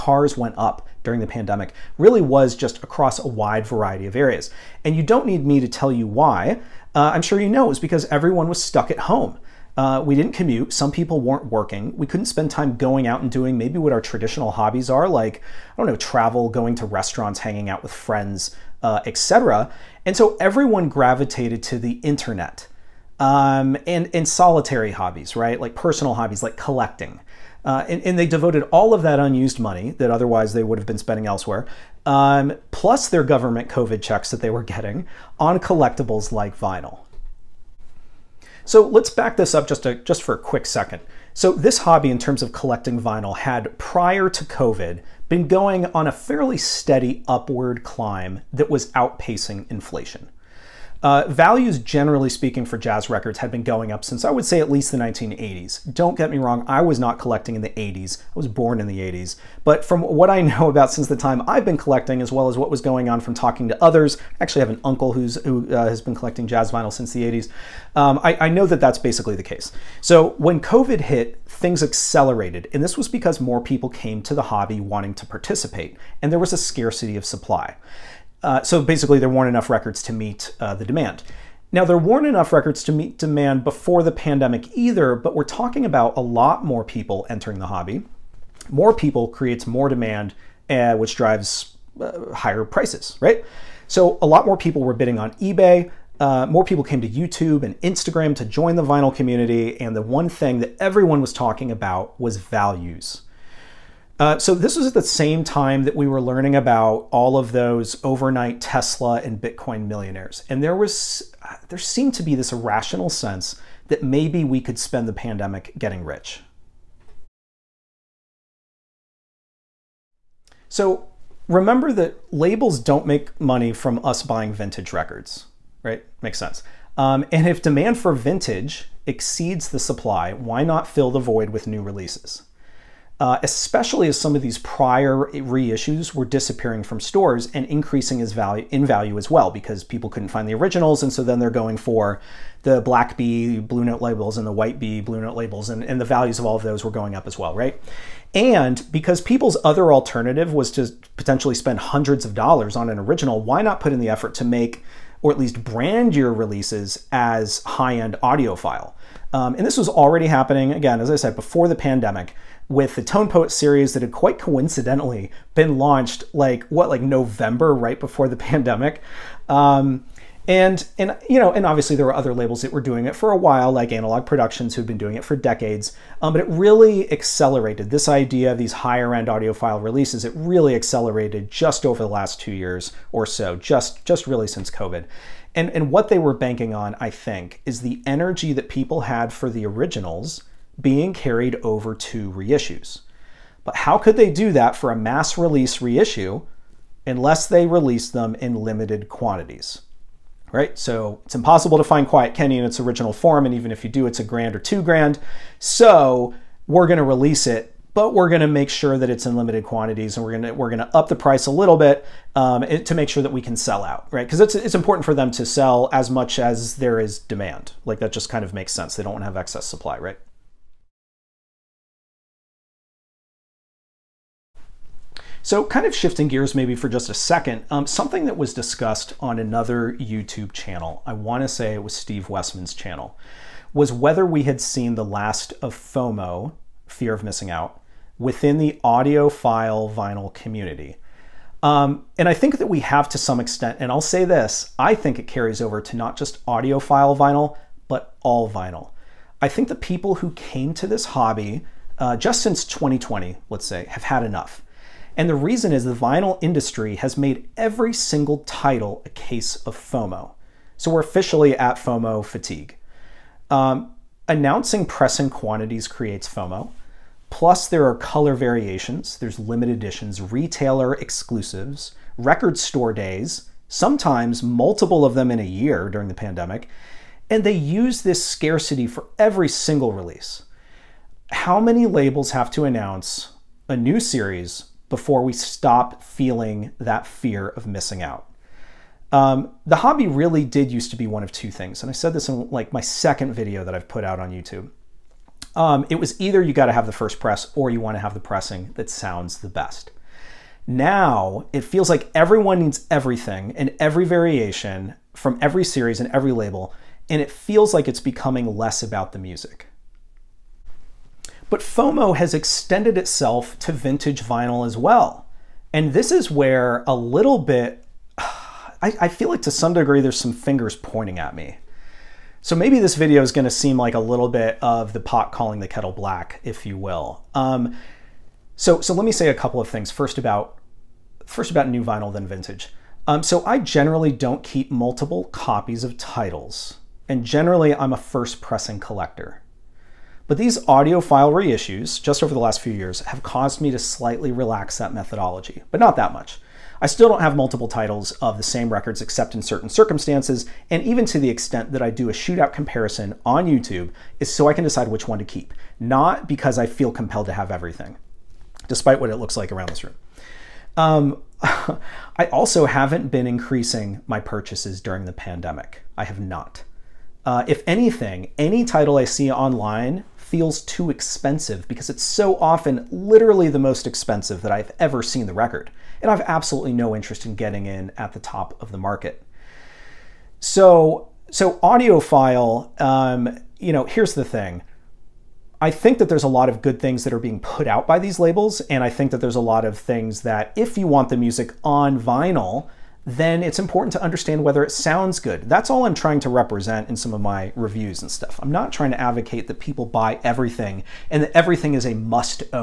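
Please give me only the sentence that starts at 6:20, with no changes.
So, so audiophile, um, you know, here's the thing.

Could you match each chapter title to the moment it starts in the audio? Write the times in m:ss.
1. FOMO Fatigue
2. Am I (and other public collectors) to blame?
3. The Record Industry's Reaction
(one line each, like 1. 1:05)
1. 3:42
2. 5:11
3. 1:58.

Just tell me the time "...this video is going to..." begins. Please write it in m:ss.
5:22.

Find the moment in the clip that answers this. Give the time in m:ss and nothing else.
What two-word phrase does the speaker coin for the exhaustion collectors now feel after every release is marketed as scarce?
4:21.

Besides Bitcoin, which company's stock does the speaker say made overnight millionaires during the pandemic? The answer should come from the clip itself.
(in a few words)
Tesla.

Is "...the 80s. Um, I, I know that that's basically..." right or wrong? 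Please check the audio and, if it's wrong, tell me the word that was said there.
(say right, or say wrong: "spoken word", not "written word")
right.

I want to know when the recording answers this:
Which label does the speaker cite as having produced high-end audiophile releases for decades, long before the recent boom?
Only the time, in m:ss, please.
2:53.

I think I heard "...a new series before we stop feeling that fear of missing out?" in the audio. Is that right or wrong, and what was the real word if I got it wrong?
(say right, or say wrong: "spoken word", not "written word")
right.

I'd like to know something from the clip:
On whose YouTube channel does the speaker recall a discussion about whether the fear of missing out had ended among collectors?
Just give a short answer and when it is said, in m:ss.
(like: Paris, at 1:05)
Steve Westman, at 3:51.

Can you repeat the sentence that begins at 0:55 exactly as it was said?
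Don't get me wrong, I was not collecting in the 80s.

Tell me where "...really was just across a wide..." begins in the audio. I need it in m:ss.
0:01.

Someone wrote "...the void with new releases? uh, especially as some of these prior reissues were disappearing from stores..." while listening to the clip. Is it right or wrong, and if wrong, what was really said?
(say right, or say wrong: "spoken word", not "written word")
right.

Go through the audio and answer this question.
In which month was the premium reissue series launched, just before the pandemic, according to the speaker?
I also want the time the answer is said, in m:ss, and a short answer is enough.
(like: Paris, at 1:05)
November, at 2:47.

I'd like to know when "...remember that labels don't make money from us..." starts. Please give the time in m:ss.
2:01.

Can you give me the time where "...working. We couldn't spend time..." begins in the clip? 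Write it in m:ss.
0:11.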